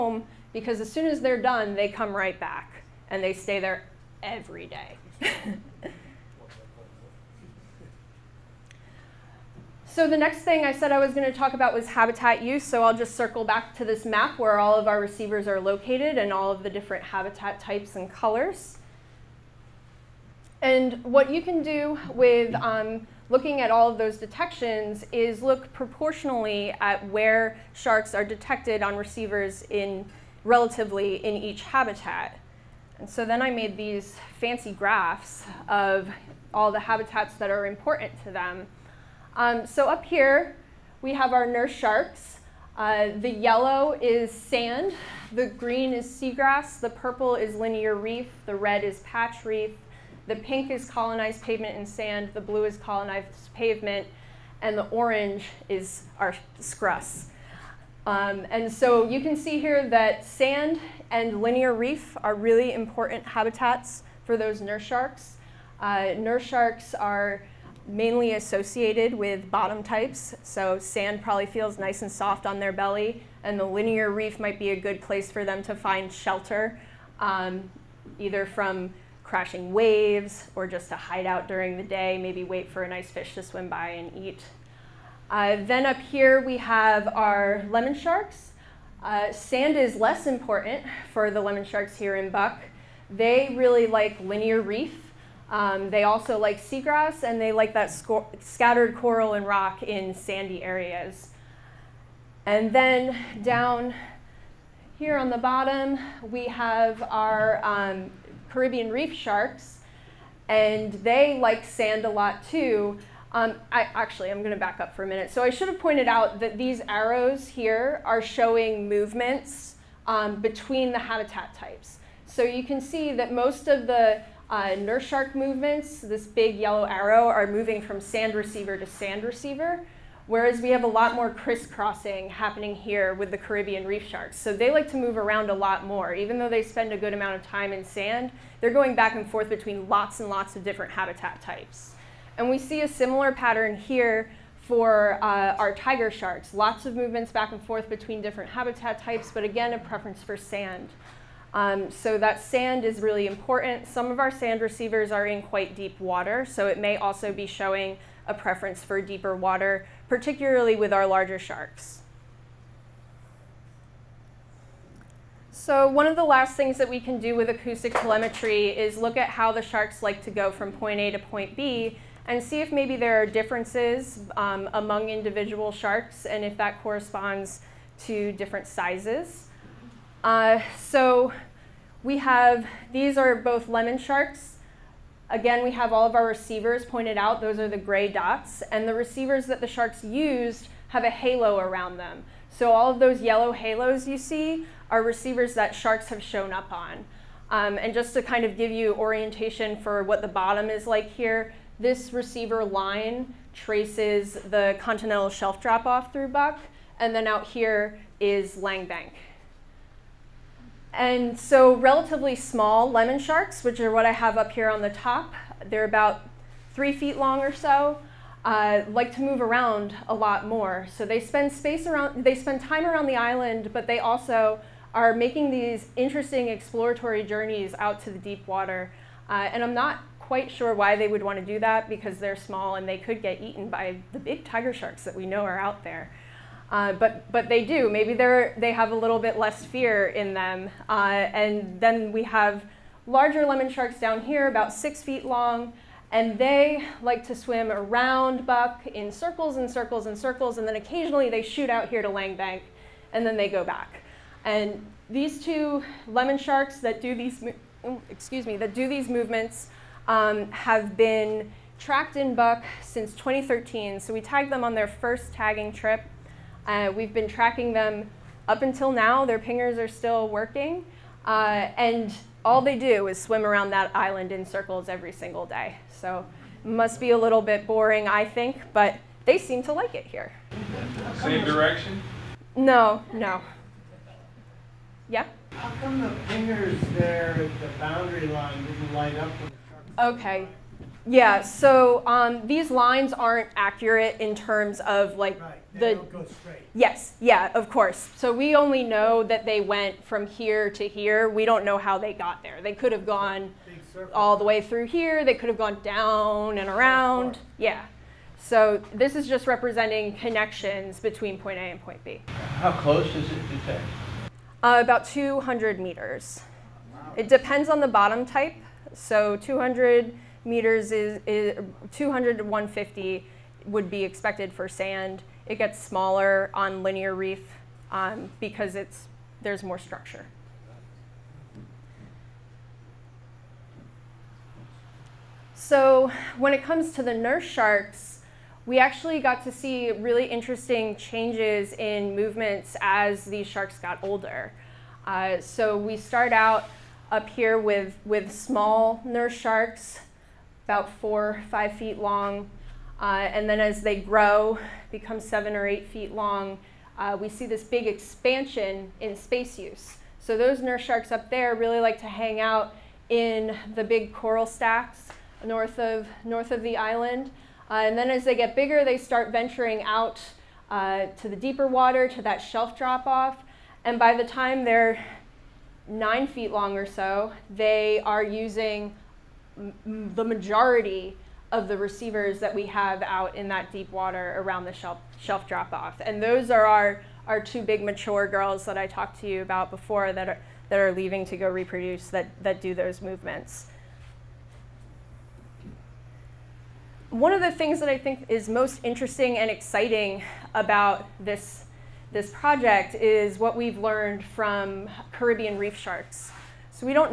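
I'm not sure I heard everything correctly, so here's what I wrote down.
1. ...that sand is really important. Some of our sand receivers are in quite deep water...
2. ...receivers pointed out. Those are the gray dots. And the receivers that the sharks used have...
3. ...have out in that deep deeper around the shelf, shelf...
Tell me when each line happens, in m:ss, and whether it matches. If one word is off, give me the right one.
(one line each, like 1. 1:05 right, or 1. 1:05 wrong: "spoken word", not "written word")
1. 2:32 right
2. 3:06 right
3. 6:22 wrong: "water", not "deeper".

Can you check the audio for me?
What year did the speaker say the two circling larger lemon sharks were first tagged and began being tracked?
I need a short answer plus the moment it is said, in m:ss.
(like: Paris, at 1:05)
2013, at 4:23.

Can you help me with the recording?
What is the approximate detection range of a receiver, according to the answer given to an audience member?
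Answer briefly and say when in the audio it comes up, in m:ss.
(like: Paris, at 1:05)
About 200 meters, at 5:14.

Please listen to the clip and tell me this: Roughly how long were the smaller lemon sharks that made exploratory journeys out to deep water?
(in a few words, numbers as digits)
About 3 feet.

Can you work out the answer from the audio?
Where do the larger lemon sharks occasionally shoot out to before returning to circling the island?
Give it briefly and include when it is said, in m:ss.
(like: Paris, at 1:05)
Lang Bank, at 4:12.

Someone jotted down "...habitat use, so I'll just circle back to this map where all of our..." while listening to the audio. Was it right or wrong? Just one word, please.
right.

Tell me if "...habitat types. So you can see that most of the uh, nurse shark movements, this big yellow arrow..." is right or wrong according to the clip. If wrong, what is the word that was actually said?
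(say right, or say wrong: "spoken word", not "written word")
right.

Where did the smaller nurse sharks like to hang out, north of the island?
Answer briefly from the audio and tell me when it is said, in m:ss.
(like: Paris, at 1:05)
Big coral stacks, at 6:03.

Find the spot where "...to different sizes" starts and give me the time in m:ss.
2:58.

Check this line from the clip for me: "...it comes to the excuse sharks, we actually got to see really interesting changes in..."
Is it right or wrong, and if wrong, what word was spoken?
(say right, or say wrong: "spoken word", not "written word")
wrong: "nurse", not "excuse".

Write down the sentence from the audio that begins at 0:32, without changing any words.
And so then I made these fancy graphs of all the habitats that are important to them.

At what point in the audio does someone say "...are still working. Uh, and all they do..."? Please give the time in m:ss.
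4:29.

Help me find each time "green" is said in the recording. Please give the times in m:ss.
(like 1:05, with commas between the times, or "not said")
0:45.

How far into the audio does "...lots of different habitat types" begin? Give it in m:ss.
2:20.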